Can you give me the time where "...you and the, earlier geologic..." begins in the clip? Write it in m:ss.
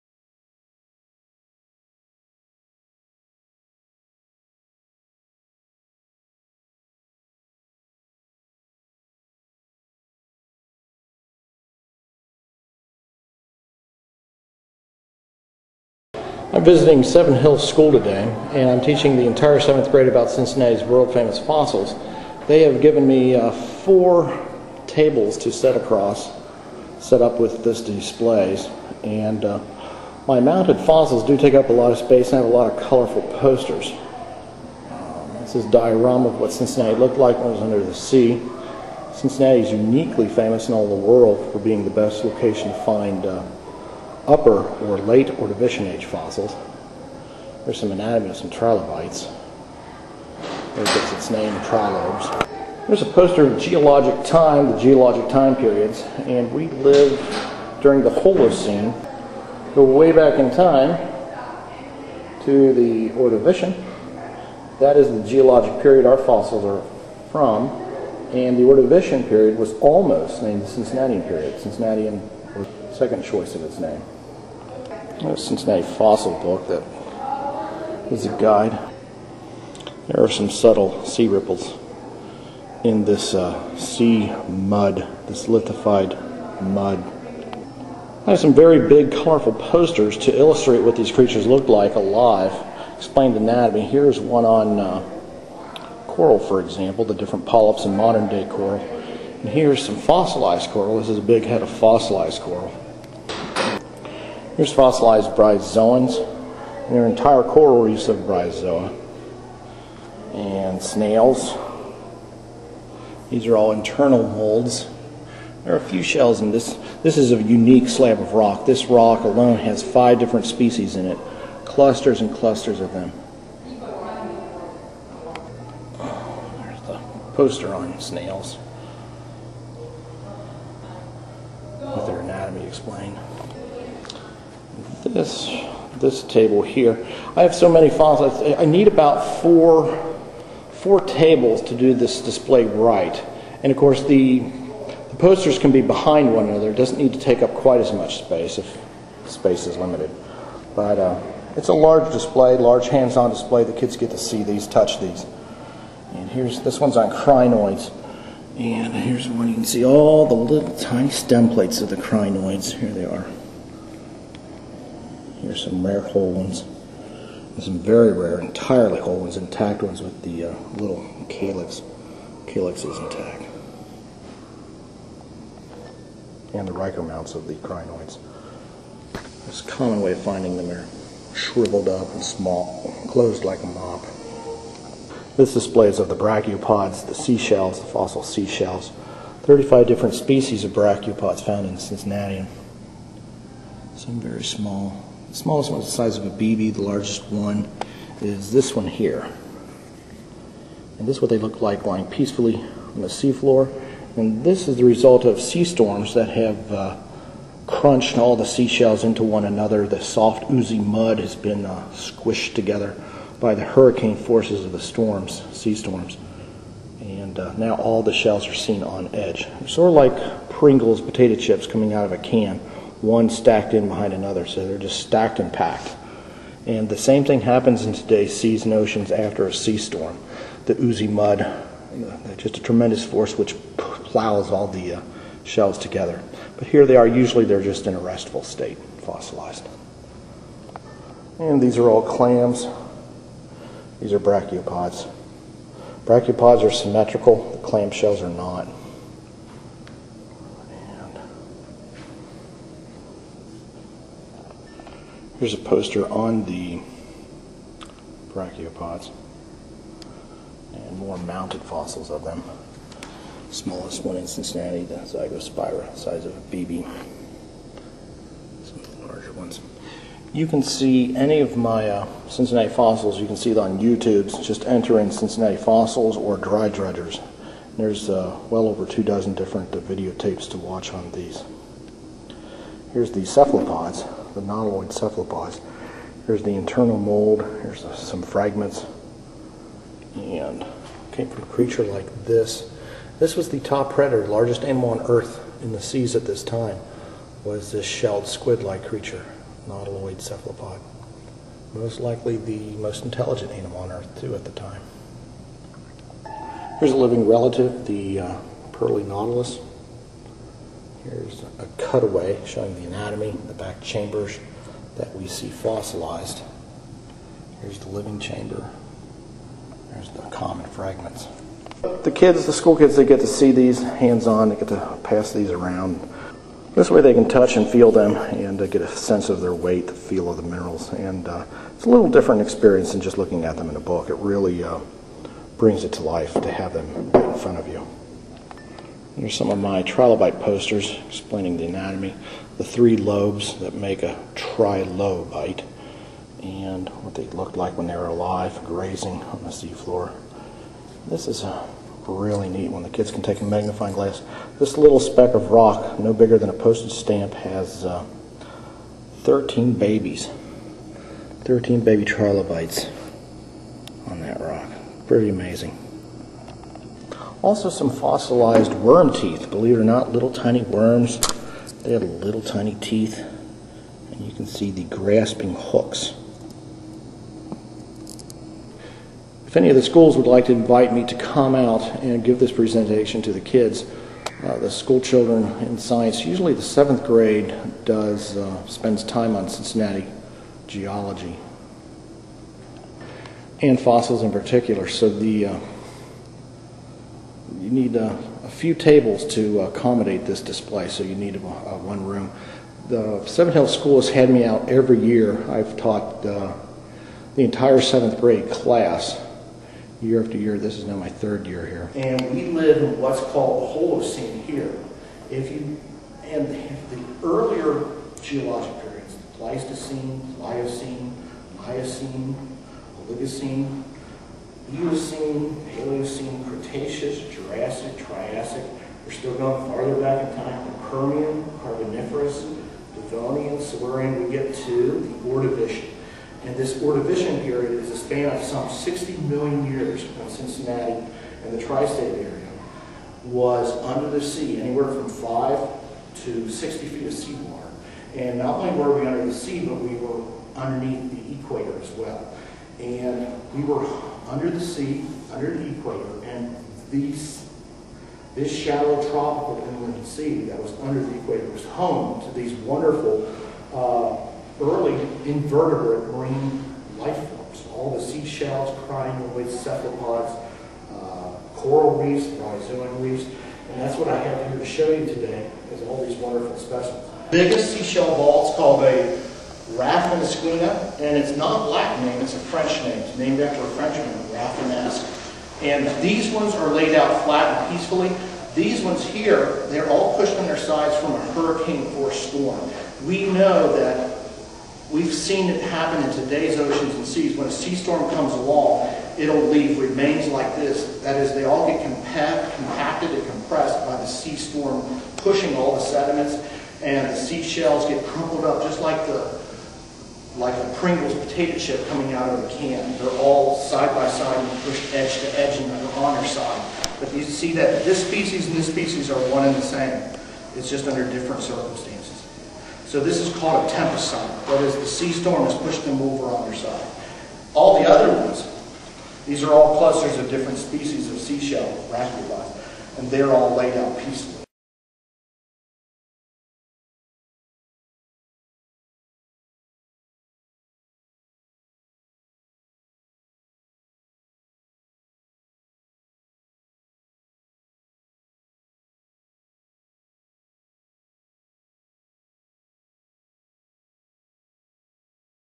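6:55.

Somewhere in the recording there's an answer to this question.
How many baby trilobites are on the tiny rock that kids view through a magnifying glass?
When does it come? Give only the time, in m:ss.
5:59.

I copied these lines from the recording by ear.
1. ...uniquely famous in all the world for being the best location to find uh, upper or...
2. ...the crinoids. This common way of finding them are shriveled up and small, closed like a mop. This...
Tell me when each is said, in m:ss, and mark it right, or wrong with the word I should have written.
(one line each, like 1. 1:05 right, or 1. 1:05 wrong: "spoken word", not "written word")
1. 0:39 right
2. 2:57 right.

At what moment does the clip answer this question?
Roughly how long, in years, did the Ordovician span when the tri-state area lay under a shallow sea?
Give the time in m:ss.
7:18.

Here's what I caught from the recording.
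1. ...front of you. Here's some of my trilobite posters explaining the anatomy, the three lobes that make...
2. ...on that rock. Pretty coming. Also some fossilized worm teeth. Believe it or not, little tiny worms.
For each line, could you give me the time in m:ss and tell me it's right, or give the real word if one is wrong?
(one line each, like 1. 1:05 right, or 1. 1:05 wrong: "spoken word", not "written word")
1. 5:37 right
2. 6:04 wrong: "amazing", not "coming".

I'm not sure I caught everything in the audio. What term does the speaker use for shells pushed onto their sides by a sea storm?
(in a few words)
tempest sign.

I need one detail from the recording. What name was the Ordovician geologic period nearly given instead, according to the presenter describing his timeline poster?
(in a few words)
Cincinnatian period.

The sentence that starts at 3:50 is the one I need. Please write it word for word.
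The oozy mud, just a tremendous force which plows all the uh, shells together.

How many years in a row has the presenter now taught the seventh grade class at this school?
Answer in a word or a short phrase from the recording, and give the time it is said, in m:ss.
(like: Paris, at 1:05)
3, at 6:51.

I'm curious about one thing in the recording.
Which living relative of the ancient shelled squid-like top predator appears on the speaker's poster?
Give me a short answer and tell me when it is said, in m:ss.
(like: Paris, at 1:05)
pearly nautilus, at 5:08.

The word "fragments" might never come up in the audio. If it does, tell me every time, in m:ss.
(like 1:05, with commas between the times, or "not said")
4:48, 5:20.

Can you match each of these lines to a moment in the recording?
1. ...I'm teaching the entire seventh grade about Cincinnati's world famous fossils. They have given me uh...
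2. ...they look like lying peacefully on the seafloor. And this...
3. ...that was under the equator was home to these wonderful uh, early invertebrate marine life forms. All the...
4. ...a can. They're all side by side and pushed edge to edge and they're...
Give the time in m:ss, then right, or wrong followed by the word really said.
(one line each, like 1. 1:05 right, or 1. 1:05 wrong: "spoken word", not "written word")
1. 0:18 right
2. 3:21 right
3. 7:40 right
4. 8:32 right.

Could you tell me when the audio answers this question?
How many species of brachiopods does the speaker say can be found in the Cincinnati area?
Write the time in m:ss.
3:09.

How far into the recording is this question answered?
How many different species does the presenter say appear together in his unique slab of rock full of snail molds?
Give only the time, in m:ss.
1:59.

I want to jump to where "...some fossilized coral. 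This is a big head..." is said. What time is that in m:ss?
1:39.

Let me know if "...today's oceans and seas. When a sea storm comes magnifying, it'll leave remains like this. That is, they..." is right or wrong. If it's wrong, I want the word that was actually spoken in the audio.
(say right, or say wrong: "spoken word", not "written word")
wrong: "along", not "magnifying".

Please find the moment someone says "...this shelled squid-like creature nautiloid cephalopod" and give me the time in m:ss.
4:57.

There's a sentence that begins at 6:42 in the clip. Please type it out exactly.
The Seven Hills School has had me out every year.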